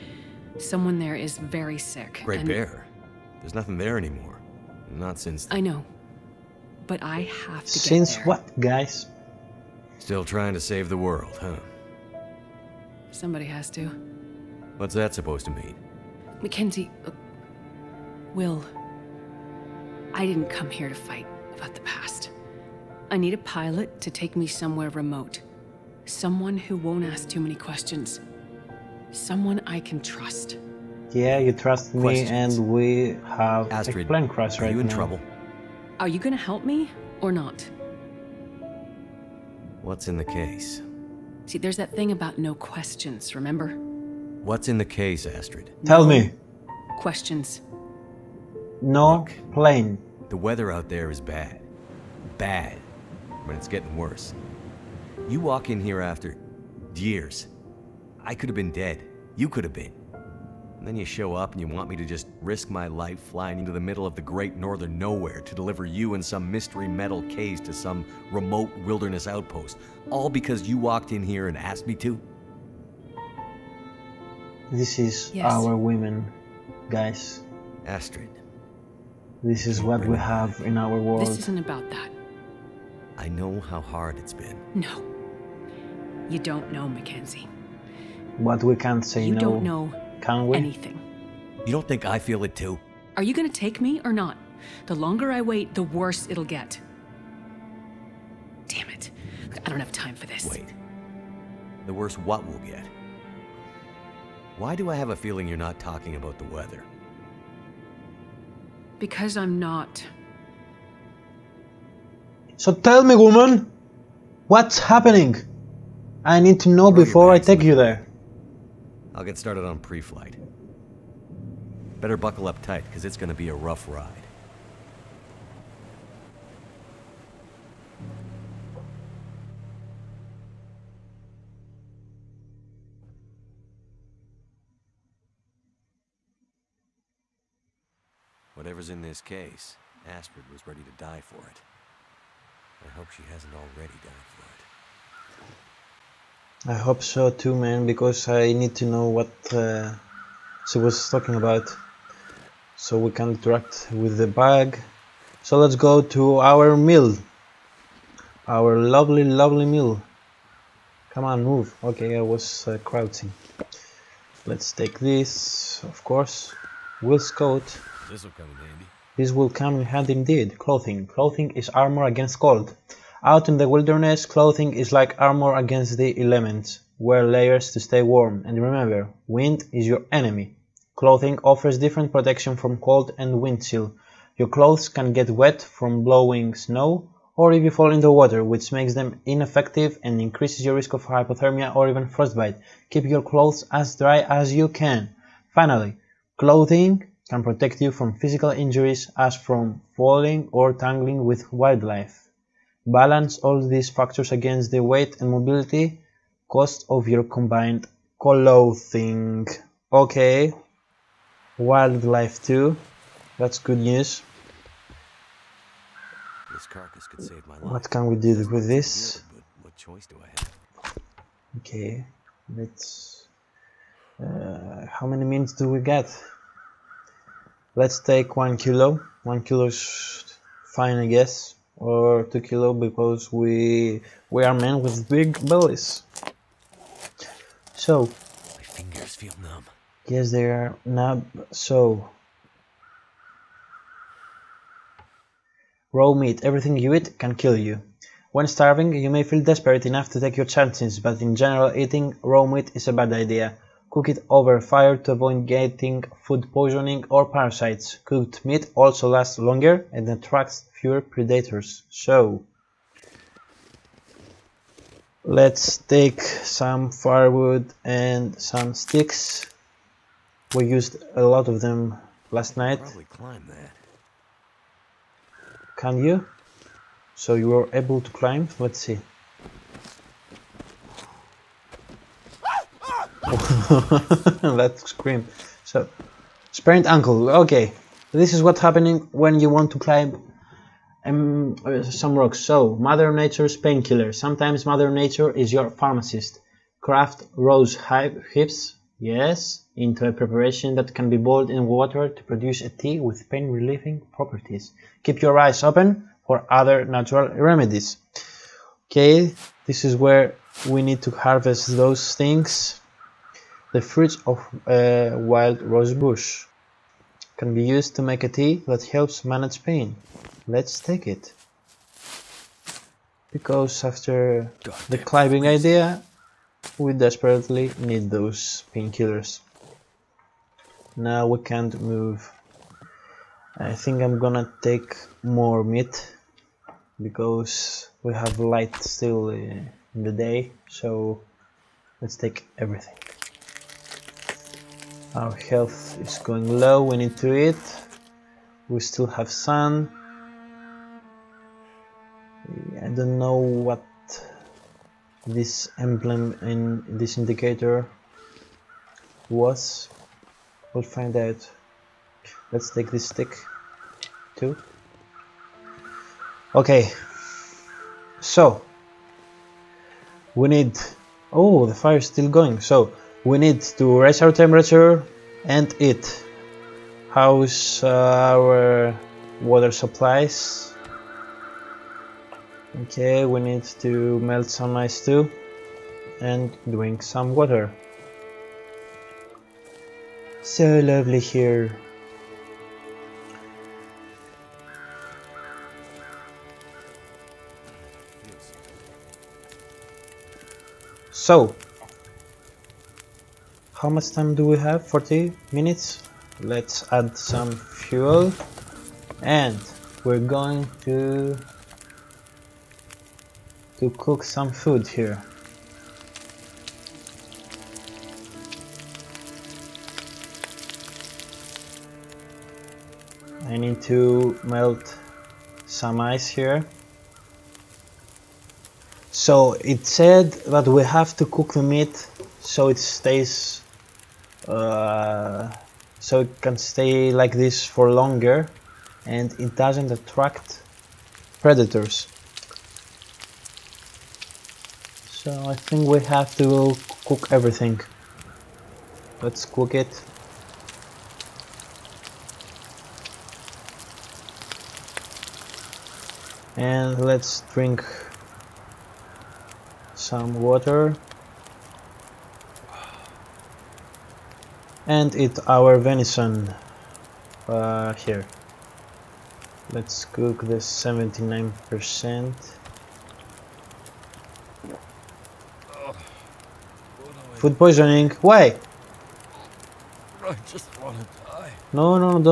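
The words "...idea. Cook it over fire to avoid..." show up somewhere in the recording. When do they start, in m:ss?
4:13.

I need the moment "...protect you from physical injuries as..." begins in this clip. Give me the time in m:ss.
3:17.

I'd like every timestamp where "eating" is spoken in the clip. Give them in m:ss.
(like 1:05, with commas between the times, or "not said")
4:11.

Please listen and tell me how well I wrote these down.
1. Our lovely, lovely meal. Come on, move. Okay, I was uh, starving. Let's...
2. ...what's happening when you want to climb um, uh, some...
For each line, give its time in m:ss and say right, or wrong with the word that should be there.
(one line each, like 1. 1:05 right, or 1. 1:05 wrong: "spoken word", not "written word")
1. 2:38 wrong: "crouching", not "starving"
2. 4:48 right.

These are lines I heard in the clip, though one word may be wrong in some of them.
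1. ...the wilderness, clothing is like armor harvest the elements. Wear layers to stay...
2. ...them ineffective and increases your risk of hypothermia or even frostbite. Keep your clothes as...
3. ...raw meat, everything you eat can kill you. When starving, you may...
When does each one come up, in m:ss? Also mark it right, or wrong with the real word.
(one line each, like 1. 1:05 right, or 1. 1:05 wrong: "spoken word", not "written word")
1. 2:53 wrong: "against", not "harvest"
2. 3:08 right
3. 4:05 right.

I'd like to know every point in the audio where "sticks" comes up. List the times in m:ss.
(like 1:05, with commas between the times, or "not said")
4:28, 6:03.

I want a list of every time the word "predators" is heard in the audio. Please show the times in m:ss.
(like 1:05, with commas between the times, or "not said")
4:21, 7:21.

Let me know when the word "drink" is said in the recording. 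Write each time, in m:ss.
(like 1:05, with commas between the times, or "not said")
6:26, 7:37.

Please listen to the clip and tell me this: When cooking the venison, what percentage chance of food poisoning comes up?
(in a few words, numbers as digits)
79%.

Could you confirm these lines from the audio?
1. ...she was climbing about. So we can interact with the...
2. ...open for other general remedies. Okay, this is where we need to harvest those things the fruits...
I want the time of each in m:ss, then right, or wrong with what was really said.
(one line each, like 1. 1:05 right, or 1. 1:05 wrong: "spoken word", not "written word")
1. 2:30 wrong: "talking", not "climbing"
2. 5:05 wrong: "natural", not "general".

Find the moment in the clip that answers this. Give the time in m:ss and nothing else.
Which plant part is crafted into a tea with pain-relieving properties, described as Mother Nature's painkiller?
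4:57.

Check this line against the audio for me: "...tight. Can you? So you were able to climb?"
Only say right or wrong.
wrong.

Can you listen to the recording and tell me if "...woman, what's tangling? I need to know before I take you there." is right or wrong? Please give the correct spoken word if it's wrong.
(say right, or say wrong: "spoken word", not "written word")
wrong: "happening", not "tangling".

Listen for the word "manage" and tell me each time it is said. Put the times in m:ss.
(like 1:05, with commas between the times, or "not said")
5:19.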